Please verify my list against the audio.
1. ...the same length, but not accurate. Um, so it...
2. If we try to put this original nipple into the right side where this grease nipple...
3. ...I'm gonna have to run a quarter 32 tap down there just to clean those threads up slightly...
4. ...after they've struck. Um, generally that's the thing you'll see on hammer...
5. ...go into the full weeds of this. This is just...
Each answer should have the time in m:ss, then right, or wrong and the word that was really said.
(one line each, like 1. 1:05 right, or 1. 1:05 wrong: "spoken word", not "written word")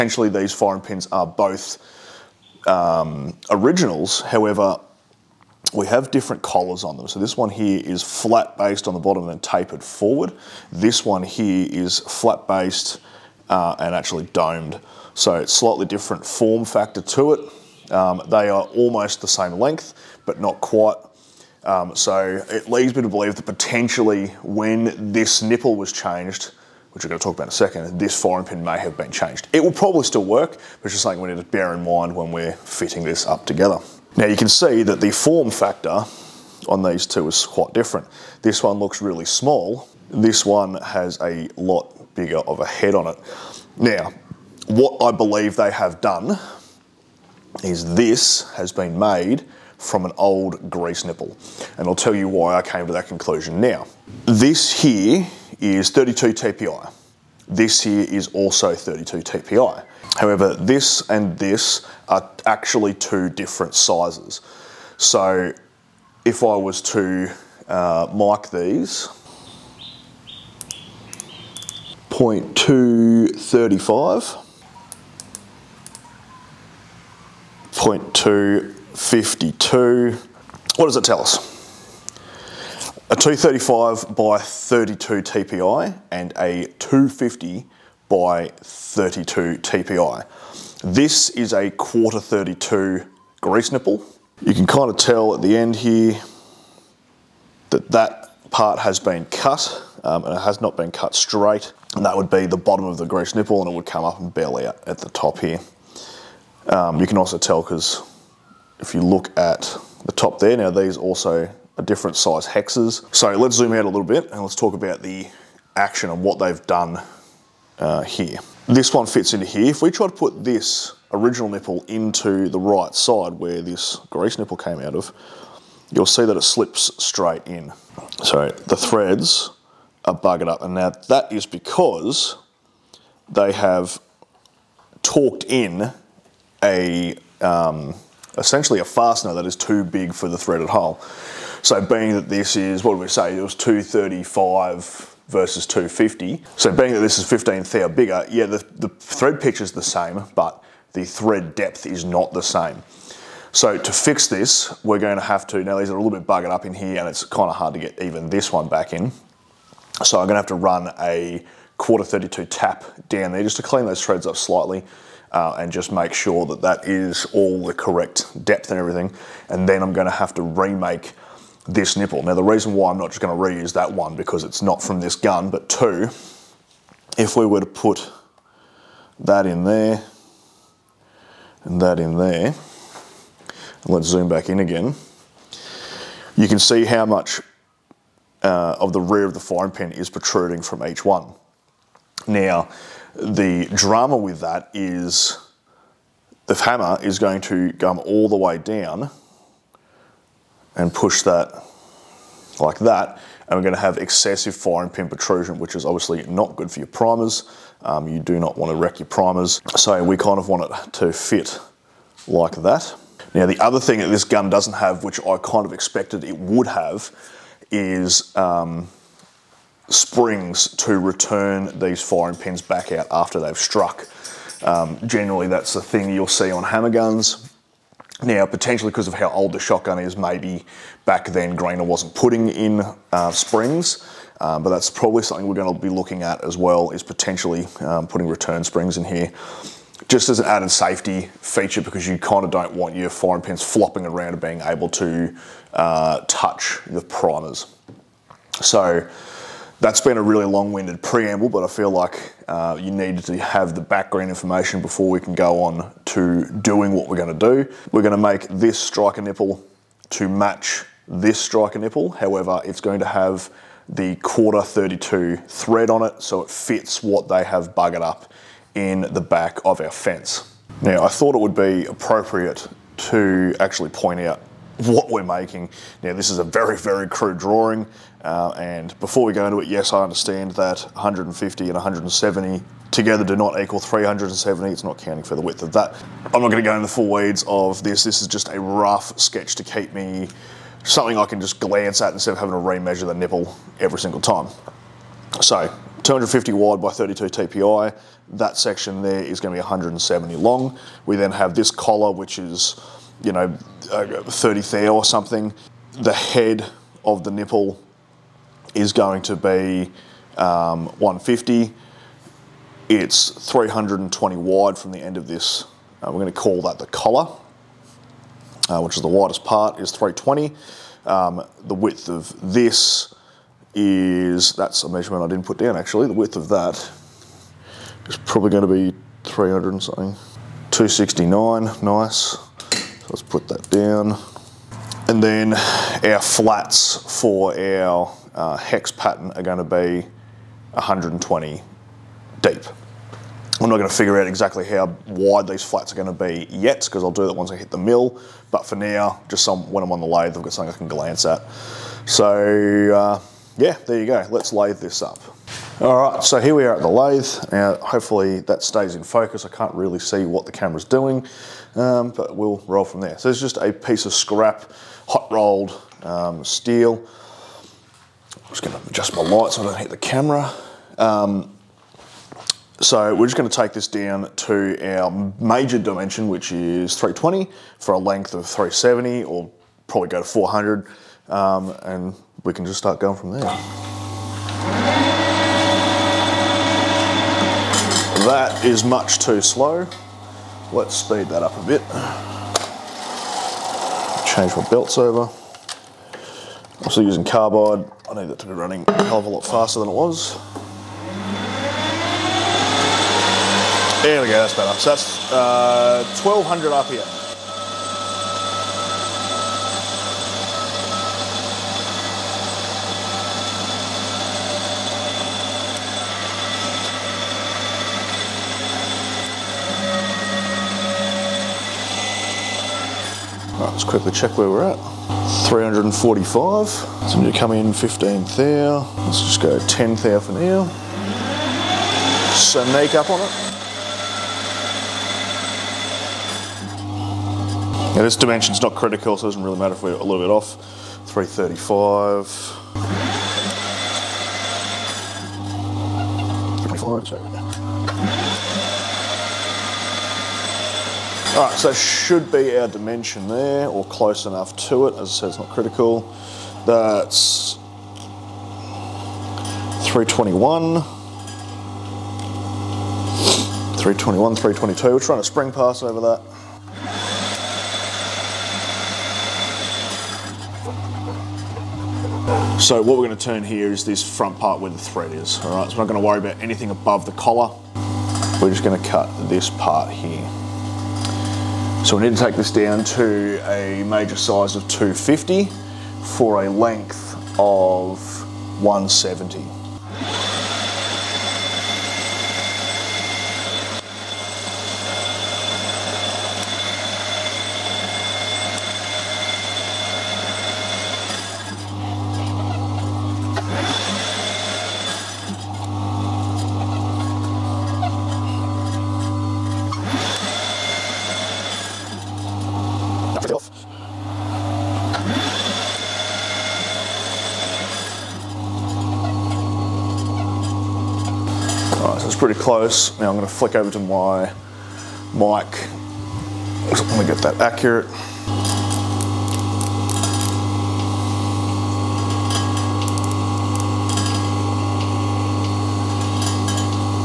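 1. 0:19 wrong: "quite", not "accurate"
2. 1:59 right
3. 2:40 right
4. 3:43 right
5. 4:46 right.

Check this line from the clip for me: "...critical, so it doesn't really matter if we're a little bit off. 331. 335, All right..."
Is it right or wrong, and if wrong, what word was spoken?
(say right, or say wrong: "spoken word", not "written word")
wrong: "335", not "331".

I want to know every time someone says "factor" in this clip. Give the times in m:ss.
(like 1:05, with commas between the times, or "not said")
0:16, 0:35.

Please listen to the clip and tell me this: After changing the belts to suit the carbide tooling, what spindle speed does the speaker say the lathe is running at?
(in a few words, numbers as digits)
1200 RPM.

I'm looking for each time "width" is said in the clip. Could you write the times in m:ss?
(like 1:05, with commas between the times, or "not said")
4:45, 5:21, 5:26.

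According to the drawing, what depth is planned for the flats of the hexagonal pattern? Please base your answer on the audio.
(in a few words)
120.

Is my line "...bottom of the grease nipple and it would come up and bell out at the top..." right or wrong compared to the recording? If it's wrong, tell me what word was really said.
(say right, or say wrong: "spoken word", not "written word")
right.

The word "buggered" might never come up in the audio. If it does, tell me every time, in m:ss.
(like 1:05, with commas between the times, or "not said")
2:10, 2:36, 4:27.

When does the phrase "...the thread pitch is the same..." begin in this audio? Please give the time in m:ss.
2:28.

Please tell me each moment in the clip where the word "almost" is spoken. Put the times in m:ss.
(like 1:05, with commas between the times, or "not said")
0:18.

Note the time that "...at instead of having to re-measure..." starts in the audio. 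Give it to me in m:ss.
4:52.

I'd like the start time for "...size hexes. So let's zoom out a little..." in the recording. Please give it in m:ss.
1:52.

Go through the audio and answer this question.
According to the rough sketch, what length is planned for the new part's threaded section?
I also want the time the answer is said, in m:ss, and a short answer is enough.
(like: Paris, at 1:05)
170, at 4:59.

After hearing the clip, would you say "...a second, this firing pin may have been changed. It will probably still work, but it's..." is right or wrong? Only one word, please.
right.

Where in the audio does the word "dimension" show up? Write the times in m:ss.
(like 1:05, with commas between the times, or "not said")
6:15, 7:18, 7:32.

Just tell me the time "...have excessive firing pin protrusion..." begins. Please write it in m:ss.
3:23.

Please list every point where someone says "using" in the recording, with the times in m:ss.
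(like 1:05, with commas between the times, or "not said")
6:37.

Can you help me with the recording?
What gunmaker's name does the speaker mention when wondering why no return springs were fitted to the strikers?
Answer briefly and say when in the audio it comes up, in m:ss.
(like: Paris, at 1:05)
Greener, at 3:51.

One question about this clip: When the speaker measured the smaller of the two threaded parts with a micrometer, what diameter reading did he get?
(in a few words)
0.235.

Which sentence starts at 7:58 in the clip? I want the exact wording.
We're just going to cut this part here.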